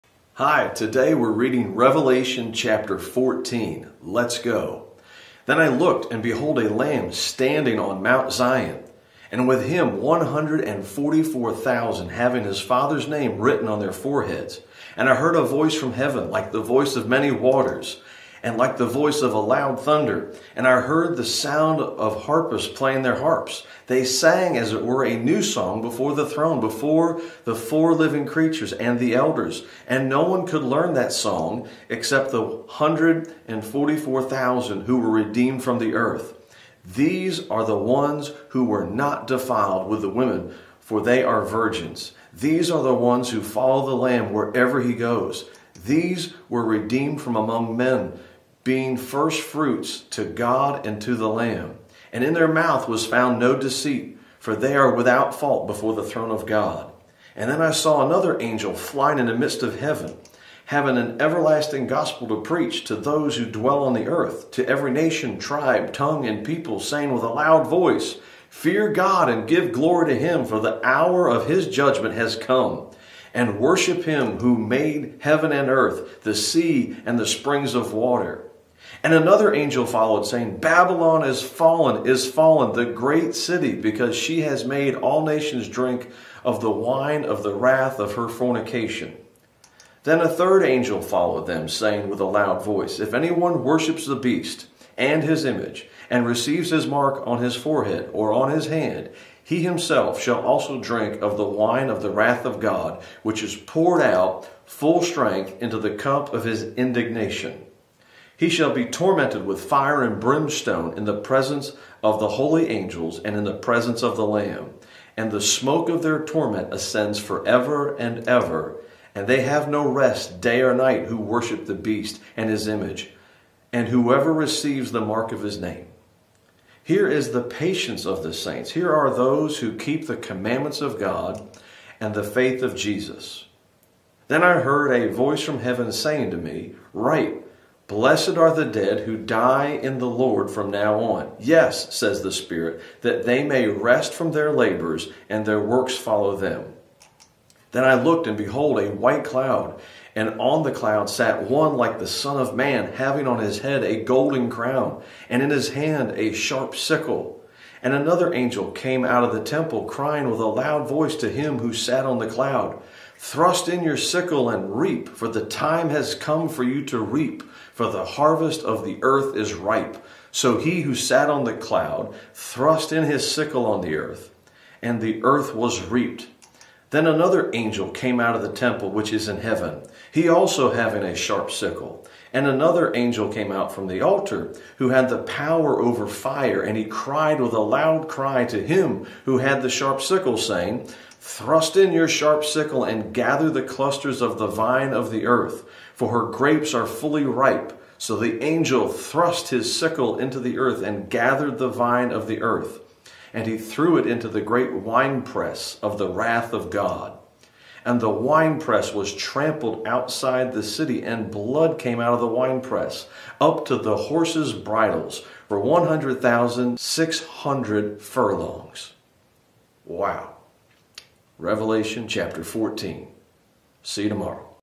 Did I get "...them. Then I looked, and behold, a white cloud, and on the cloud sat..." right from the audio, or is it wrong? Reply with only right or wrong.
right.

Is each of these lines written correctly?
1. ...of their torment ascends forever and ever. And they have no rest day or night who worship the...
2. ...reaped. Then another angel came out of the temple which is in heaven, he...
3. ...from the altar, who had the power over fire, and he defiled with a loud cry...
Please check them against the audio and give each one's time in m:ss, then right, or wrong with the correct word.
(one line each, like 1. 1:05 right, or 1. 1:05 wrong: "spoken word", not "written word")
1. 1:55 right
2. 2:55 right
3. 3:03 wrong: "cried", not "defiled".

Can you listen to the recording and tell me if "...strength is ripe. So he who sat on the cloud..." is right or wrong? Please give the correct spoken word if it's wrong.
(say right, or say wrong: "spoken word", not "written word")
wrong: "earth", not "strength".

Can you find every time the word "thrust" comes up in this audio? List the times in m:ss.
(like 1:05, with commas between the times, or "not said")
2:43, 2:52, 3:11, 3:18.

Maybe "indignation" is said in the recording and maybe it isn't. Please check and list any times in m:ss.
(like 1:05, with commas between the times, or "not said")
1:46.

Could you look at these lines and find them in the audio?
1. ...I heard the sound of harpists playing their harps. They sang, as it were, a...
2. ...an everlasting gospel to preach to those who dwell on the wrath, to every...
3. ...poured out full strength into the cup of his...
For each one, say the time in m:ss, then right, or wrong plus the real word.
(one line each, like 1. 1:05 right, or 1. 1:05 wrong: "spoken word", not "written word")
1. 0:20 right
2. 1:00 wrong: "earth", not "wrath"
3. 1:43 right.